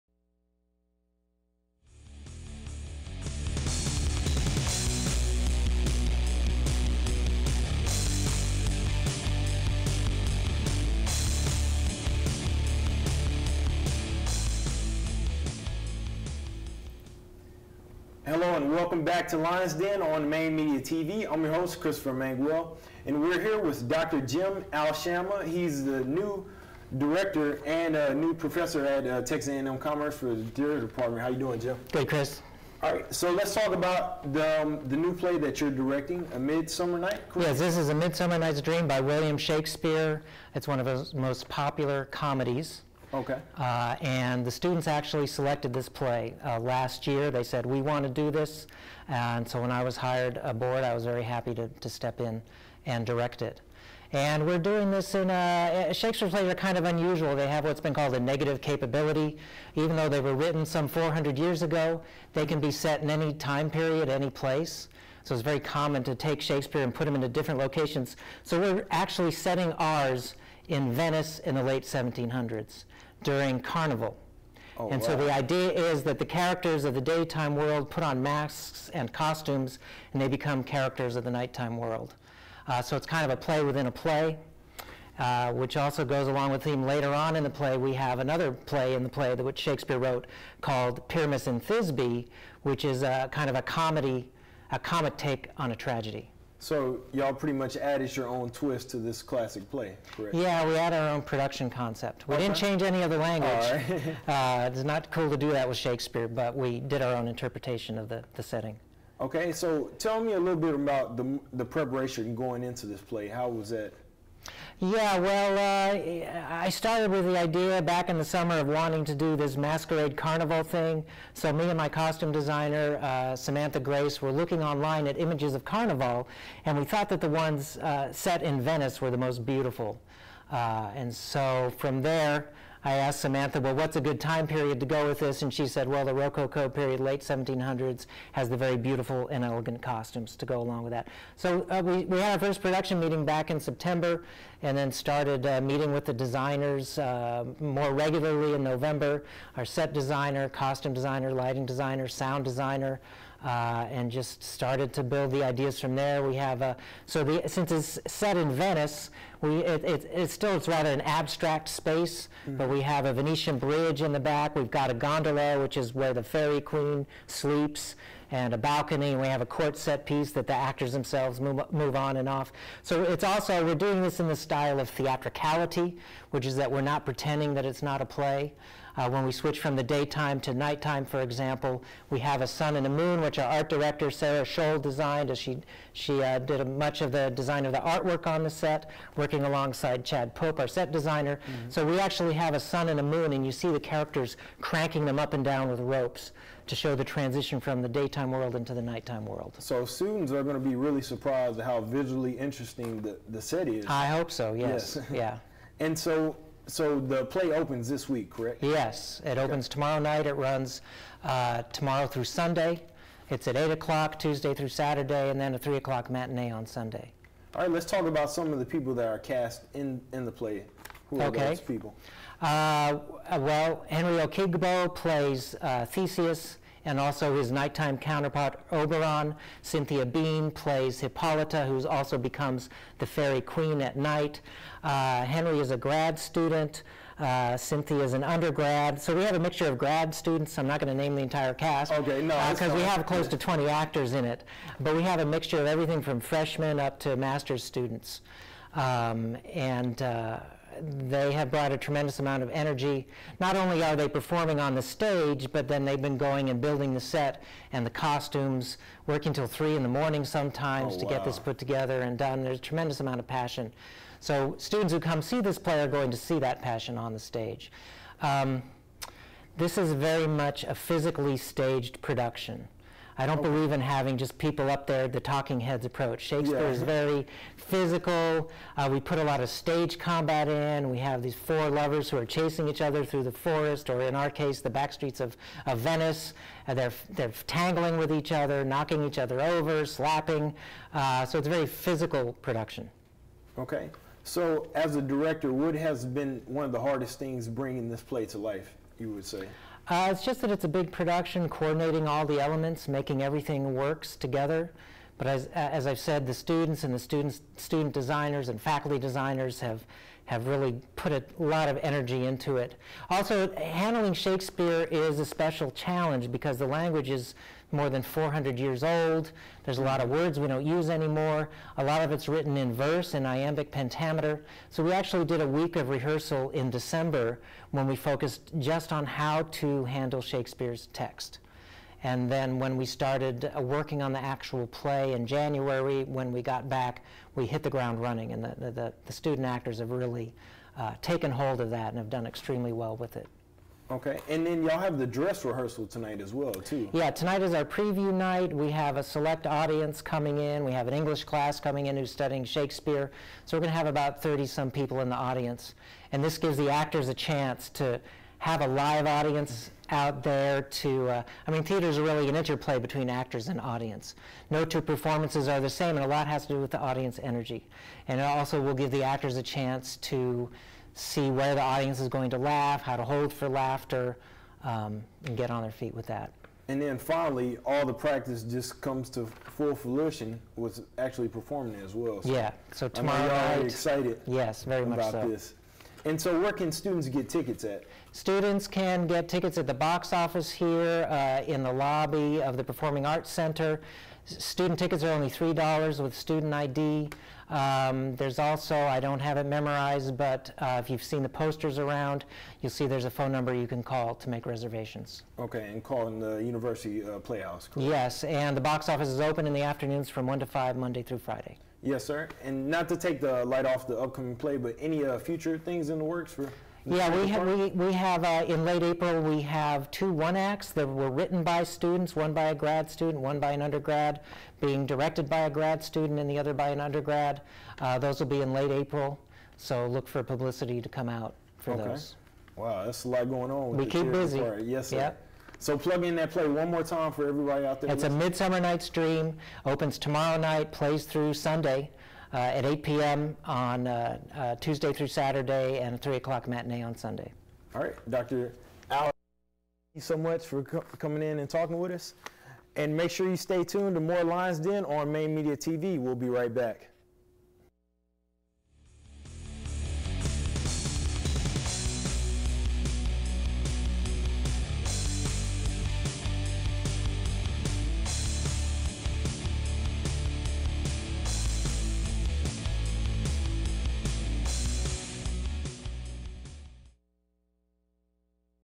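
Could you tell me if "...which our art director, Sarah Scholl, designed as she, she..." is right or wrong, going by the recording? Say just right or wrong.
right.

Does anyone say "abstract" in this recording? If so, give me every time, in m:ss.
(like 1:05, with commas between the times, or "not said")
2:41.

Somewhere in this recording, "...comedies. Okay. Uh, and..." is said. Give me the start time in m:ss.
0:42.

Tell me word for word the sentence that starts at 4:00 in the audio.
I'm not going to name the entire cast.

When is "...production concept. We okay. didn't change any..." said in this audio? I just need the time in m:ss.
1:41.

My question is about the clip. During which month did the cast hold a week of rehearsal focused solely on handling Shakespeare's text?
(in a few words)
December.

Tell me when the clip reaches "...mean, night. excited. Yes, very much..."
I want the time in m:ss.
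6:23.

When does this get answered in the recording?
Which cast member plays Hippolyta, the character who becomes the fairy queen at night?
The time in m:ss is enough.
3:49.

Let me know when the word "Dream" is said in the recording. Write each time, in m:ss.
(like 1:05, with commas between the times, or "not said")
0:38, 7:18.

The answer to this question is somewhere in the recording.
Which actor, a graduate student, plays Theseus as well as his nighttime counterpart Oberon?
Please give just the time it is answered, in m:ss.
3:43.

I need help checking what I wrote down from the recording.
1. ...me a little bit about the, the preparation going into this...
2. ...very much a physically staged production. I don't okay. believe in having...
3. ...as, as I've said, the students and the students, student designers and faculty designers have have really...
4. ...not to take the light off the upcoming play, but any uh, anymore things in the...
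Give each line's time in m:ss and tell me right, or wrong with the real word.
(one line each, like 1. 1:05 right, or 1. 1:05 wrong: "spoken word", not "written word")
1. 1:50 right
2. 4:29 right
3. 5:05 right
4. 6:52 wrong: "future", not "anymore".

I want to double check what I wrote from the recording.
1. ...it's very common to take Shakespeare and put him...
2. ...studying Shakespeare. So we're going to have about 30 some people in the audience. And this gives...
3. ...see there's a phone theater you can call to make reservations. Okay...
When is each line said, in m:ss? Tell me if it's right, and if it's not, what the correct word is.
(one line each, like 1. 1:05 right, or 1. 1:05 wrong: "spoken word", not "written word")
1. 1:05 right
2. 5:52 right
3. 6:42 wrong: "number", not "theater".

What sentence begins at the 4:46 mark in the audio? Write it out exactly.
Uh, they're, they're tangling with each other, knocking each other over, slapping.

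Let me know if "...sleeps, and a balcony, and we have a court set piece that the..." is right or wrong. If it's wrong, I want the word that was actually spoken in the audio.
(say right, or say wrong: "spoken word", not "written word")
right.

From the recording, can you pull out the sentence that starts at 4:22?
There's a tremendous amount of passion.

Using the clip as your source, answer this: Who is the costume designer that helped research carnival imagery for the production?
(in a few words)
Samantha Grace.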